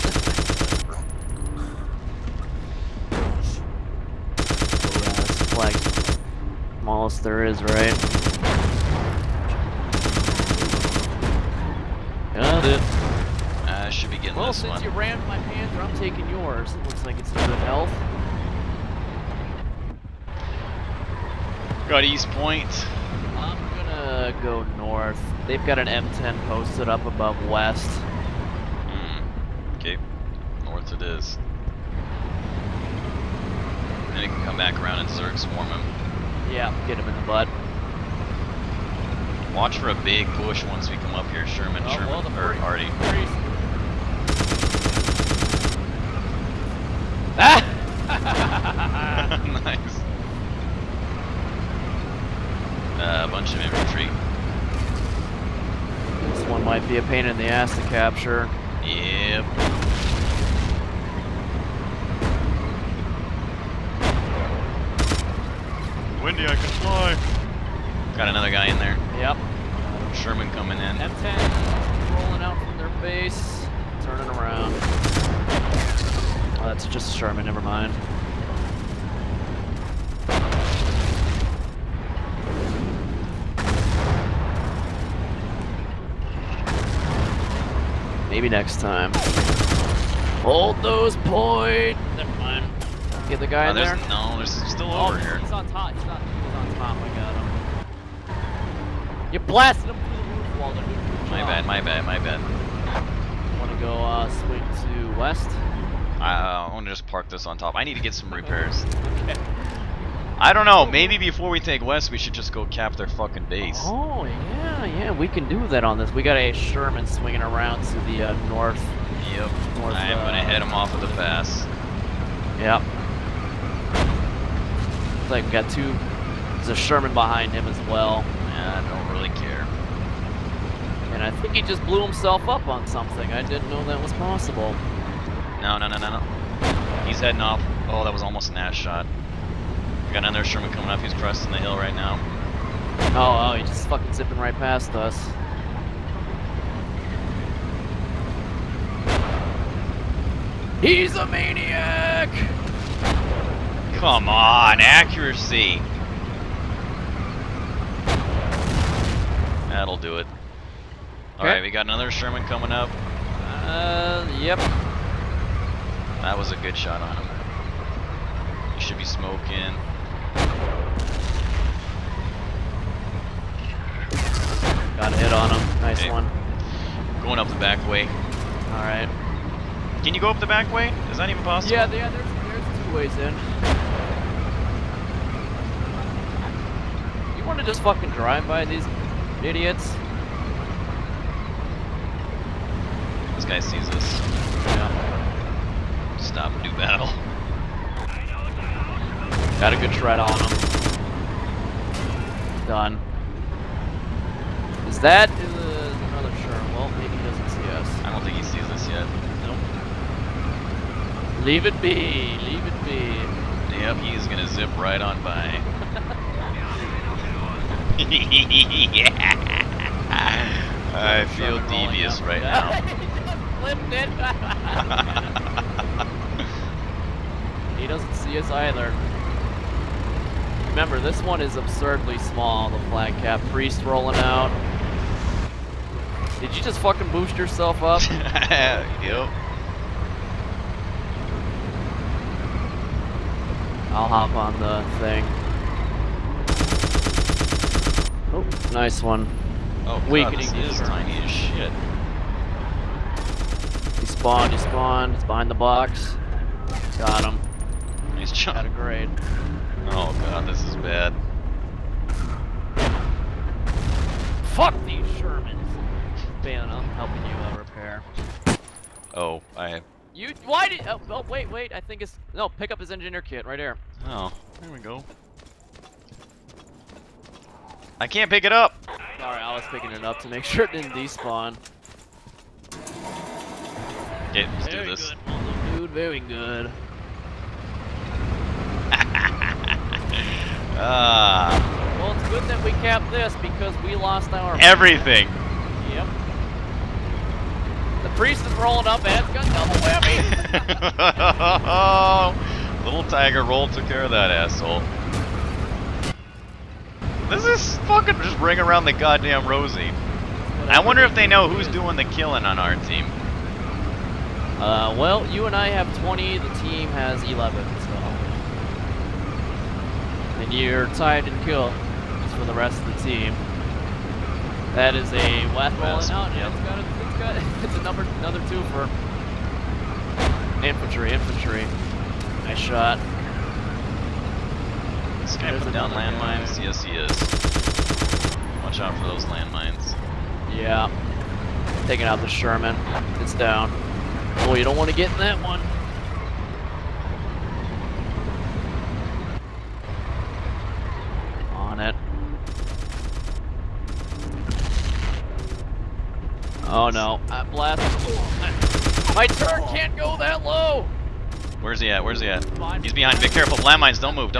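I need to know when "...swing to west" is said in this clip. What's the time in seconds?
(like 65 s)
104 s.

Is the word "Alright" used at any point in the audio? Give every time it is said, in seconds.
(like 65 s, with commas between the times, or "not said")
161 s, 178 s.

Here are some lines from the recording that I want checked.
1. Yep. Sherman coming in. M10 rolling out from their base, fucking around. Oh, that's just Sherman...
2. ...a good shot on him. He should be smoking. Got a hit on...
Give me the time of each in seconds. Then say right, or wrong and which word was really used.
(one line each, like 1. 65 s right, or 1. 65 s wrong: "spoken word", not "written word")
1. 69 s wrong: "turning", not "fucking"
2. 166 s right.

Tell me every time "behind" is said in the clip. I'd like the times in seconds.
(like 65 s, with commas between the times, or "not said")
127 s, 255 s, 362 s.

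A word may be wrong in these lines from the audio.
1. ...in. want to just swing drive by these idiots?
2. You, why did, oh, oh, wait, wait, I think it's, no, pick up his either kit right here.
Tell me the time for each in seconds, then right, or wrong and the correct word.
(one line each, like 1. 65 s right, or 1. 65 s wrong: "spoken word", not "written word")
1. 183 s wrong: "fucking", not "swing"
2. 270 s wrong: "engineer", not "either".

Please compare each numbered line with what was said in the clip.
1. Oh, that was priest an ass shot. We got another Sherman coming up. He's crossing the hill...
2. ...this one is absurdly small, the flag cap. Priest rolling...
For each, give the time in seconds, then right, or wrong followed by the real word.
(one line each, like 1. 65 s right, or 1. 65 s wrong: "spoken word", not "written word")
1. 137 s wrong: "almost", not "priest"
2. 230 s right.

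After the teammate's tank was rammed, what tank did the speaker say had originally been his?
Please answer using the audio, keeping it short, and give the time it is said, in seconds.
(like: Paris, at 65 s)
Panther, at 15 s.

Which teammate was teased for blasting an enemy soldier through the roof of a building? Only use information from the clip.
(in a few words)
Walter.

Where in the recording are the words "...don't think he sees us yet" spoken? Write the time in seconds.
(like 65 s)
208 s.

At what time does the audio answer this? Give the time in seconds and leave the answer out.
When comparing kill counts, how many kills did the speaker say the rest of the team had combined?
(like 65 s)
317 s.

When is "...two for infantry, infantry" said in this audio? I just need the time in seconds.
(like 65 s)
328 s.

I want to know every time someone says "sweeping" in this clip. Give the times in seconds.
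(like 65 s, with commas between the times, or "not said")
not said.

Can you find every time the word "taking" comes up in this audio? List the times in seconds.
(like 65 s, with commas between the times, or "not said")
15 s, 341 s.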